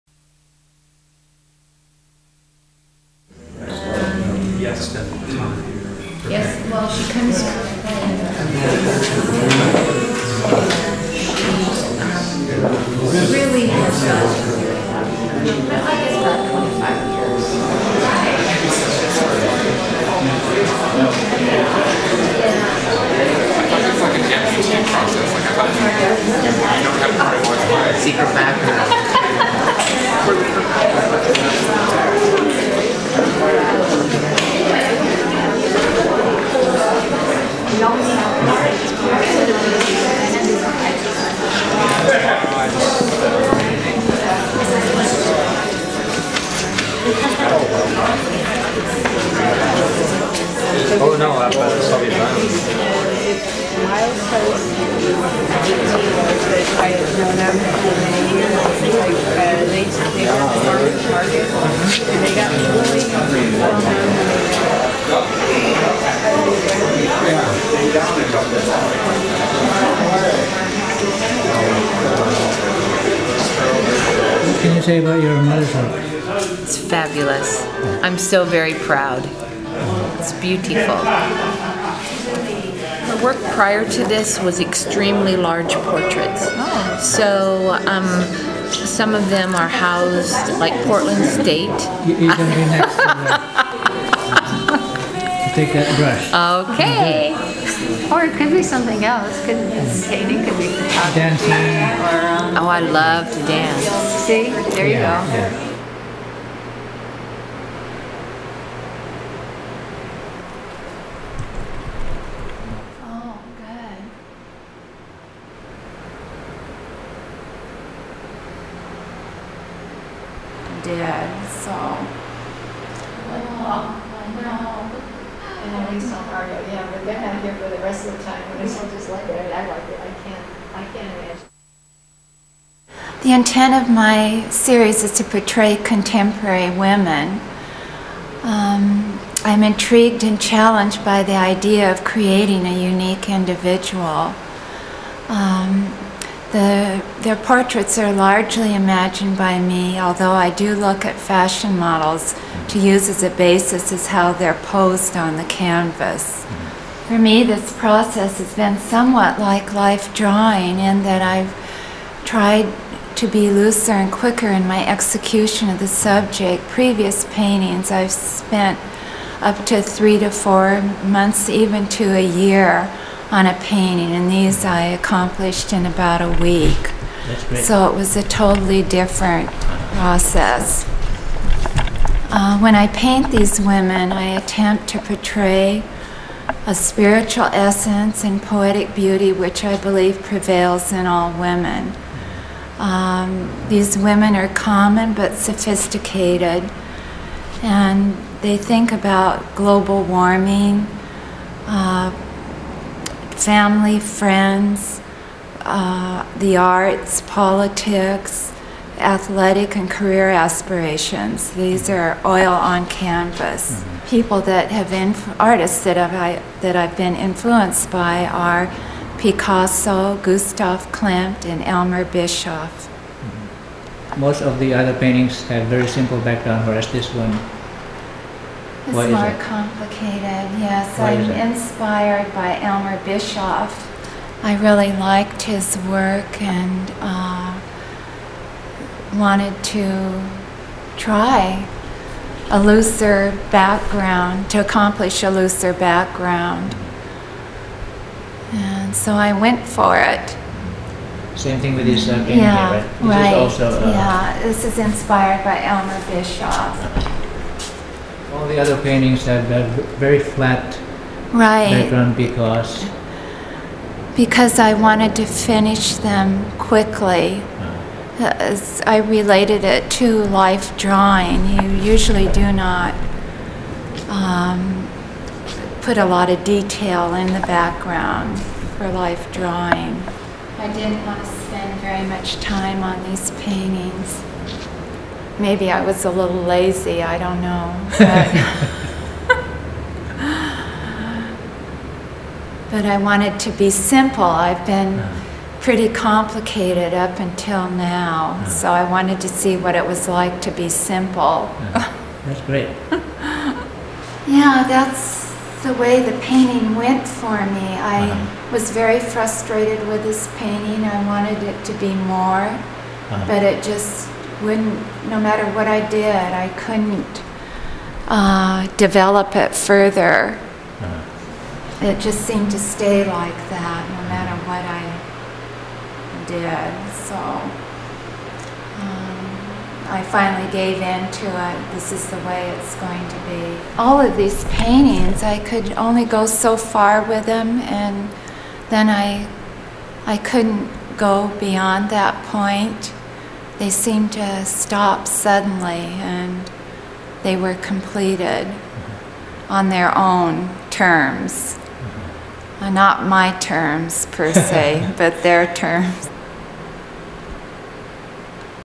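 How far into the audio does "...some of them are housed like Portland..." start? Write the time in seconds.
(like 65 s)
88 s.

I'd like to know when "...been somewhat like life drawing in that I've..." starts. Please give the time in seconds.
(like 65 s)
158 s.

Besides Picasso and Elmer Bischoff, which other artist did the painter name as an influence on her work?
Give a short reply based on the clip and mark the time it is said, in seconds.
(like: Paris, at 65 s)
Gustav Klimt, at 220 s.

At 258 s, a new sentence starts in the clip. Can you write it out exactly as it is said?
All the other paintings have a very flat right.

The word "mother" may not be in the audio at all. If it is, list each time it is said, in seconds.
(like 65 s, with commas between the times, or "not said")
75 s.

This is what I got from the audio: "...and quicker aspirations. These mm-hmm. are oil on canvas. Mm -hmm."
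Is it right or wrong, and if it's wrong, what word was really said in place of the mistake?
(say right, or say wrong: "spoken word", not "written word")
wrong: "career", not "quicker".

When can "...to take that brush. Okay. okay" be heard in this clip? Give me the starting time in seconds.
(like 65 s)
95 s.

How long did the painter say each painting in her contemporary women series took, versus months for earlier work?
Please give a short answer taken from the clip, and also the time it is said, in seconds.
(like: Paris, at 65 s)
about a week, at 175 s.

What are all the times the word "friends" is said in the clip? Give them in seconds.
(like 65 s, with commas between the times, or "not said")
203 s.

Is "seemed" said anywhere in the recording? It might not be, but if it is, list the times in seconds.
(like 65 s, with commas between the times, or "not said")
322 s, 343 s.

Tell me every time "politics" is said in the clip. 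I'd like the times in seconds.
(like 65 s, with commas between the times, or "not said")
207 s.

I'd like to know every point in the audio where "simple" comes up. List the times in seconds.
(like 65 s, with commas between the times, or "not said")
225 s, 293 s, 300 s.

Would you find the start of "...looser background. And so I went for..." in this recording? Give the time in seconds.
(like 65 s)
245 s.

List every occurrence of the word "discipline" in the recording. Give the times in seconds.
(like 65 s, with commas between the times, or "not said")
not said.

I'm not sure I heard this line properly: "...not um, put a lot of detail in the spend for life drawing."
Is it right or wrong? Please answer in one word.
wrong.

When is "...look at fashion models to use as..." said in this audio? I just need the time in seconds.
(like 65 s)
150 s.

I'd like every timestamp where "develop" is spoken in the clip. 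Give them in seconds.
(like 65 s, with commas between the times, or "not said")
318 s.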